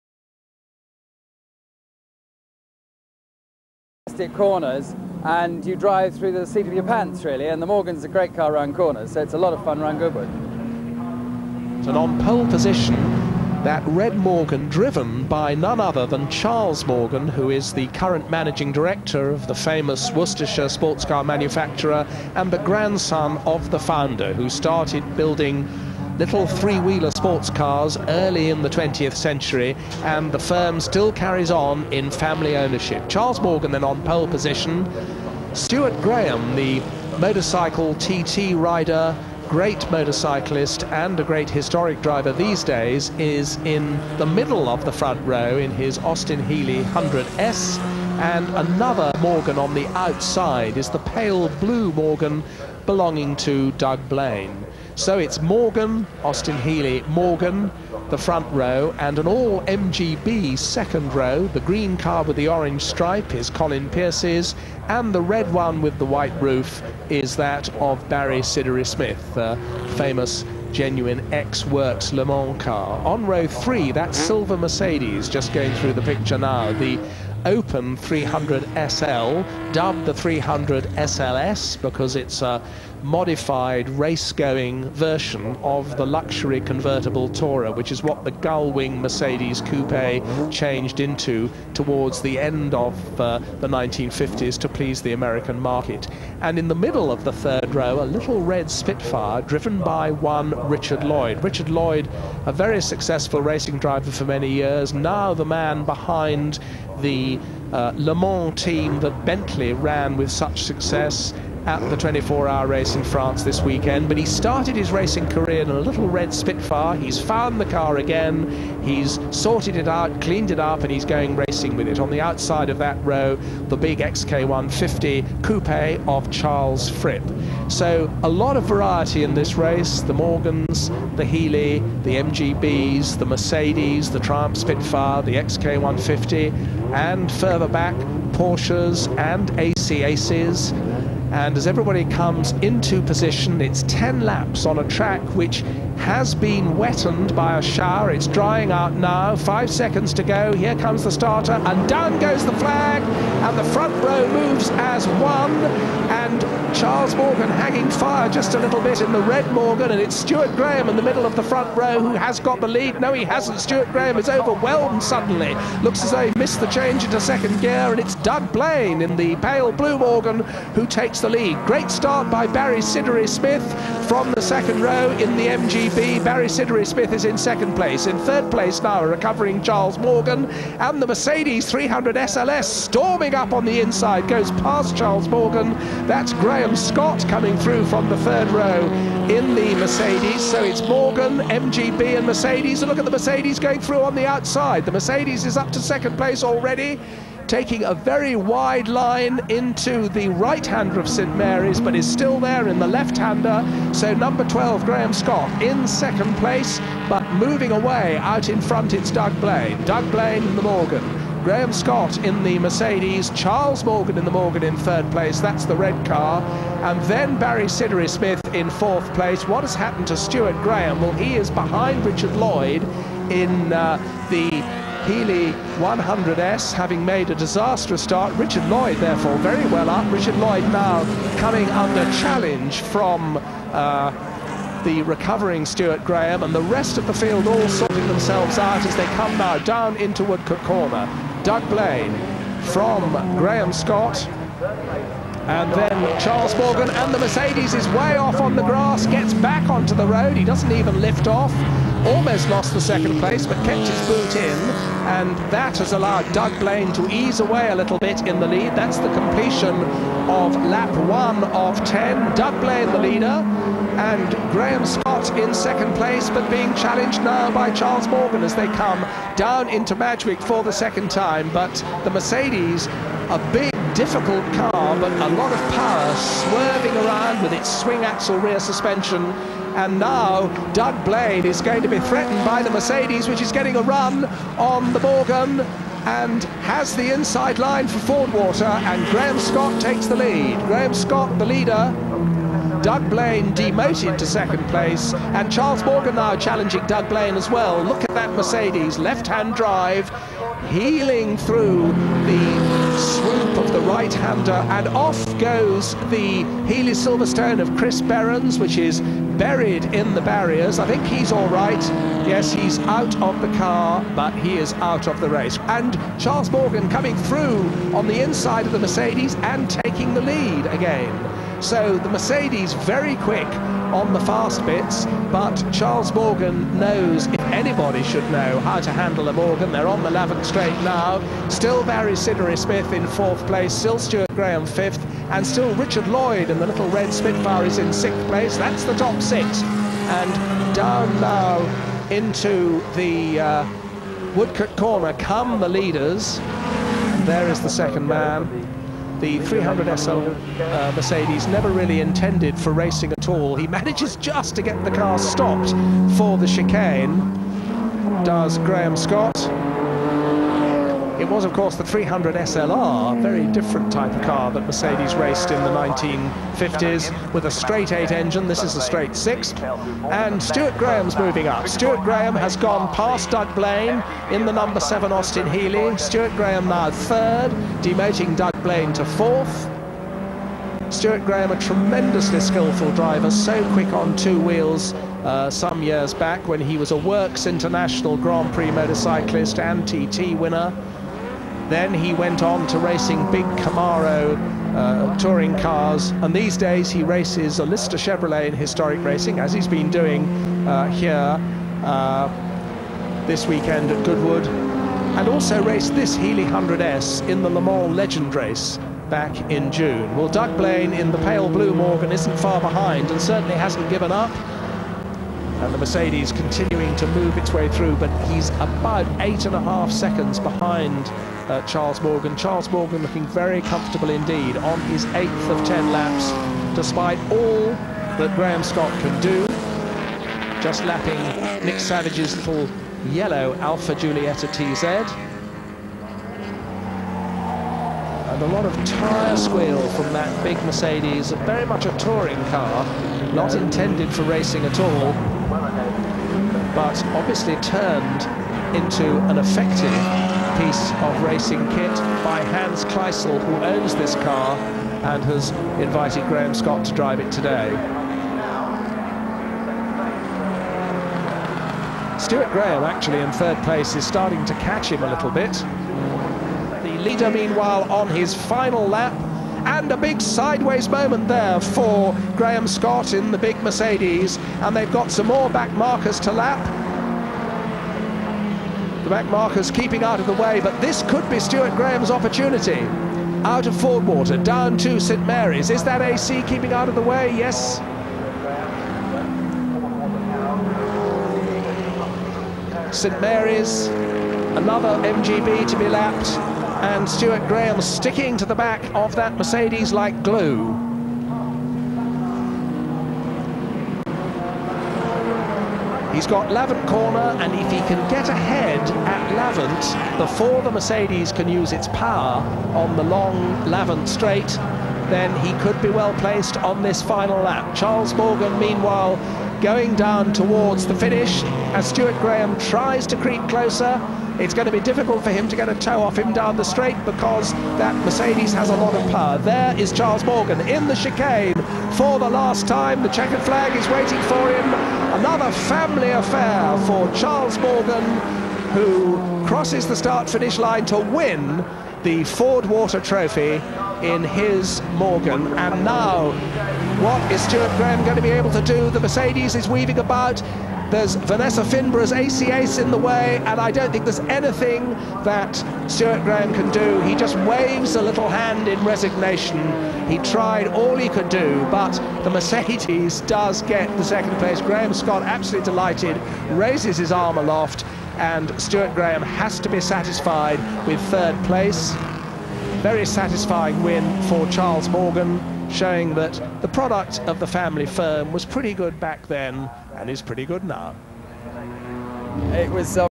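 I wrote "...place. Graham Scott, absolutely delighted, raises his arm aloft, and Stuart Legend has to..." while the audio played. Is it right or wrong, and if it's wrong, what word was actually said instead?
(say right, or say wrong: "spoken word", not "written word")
wrong: "Graham", not "Legend".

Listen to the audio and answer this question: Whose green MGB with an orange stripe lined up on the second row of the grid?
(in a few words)
Colin Pierce.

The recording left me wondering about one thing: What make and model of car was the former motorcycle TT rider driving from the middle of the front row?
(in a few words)
Austin Healey 100S.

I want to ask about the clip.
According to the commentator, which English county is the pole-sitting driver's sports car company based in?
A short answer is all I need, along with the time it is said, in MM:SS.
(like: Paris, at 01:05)
Worcestershire, at 00:20.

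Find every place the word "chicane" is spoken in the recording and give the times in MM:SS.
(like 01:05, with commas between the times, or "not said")
05:56, 08:50.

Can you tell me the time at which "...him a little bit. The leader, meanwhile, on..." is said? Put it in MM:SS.
07:44.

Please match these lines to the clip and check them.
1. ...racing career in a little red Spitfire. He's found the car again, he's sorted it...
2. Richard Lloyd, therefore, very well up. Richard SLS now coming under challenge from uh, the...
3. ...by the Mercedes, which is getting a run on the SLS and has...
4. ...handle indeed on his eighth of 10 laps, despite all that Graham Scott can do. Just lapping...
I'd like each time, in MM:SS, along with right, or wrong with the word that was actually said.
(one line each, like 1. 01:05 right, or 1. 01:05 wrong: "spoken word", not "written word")
1. 01:54 right
2. 03:48 wrong: "Lloyd", not "SLS"
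3. 04:42 wrong: "Morgan", not "SLS"
4. 07:03 wrong: "comfortable", not "handle".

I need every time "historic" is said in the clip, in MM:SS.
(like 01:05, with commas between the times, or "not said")
00:41, 06:38.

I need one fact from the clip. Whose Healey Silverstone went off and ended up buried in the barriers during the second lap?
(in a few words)
Chris Berens.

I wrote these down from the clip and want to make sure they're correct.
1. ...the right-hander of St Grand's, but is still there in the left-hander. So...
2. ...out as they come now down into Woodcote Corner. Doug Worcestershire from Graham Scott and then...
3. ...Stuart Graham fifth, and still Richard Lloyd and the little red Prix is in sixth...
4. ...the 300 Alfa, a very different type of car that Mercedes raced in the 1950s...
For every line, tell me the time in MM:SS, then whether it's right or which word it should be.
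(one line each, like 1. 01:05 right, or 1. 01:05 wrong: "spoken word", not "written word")
1. 03:20 wrong: "Mary", not "Grand"
2. 03:58 wrong: "Blaine", not "Worcestershire"
3. 05:33 wrong: "Spitfire", not "Prix"
4. 06:01 wrong: "SLR", not "Alfa".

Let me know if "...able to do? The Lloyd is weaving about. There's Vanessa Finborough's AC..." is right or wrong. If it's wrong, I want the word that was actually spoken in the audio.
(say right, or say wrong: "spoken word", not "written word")
wrong: "Mercedes", not "Lloyd".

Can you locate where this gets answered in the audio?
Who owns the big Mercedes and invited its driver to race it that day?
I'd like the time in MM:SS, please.
07:32.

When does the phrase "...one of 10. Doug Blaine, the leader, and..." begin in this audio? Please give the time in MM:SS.
04:21.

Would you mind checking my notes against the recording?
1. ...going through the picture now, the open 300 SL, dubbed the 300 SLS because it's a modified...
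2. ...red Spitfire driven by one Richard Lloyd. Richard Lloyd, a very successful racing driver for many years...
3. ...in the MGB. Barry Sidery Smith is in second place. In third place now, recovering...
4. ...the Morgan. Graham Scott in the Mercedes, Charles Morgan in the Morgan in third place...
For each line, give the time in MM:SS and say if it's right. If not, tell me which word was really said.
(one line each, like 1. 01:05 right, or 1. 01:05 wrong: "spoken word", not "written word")
1. 01:15 right
2. 01:38 right
3. 02:55 right
4. 03:30 right.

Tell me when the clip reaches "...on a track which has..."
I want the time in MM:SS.
02:24.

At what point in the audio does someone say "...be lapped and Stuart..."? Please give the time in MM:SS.
08:15.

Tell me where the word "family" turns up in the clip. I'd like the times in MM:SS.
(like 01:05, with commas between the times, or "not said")
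00:32, 08:55, 09:37.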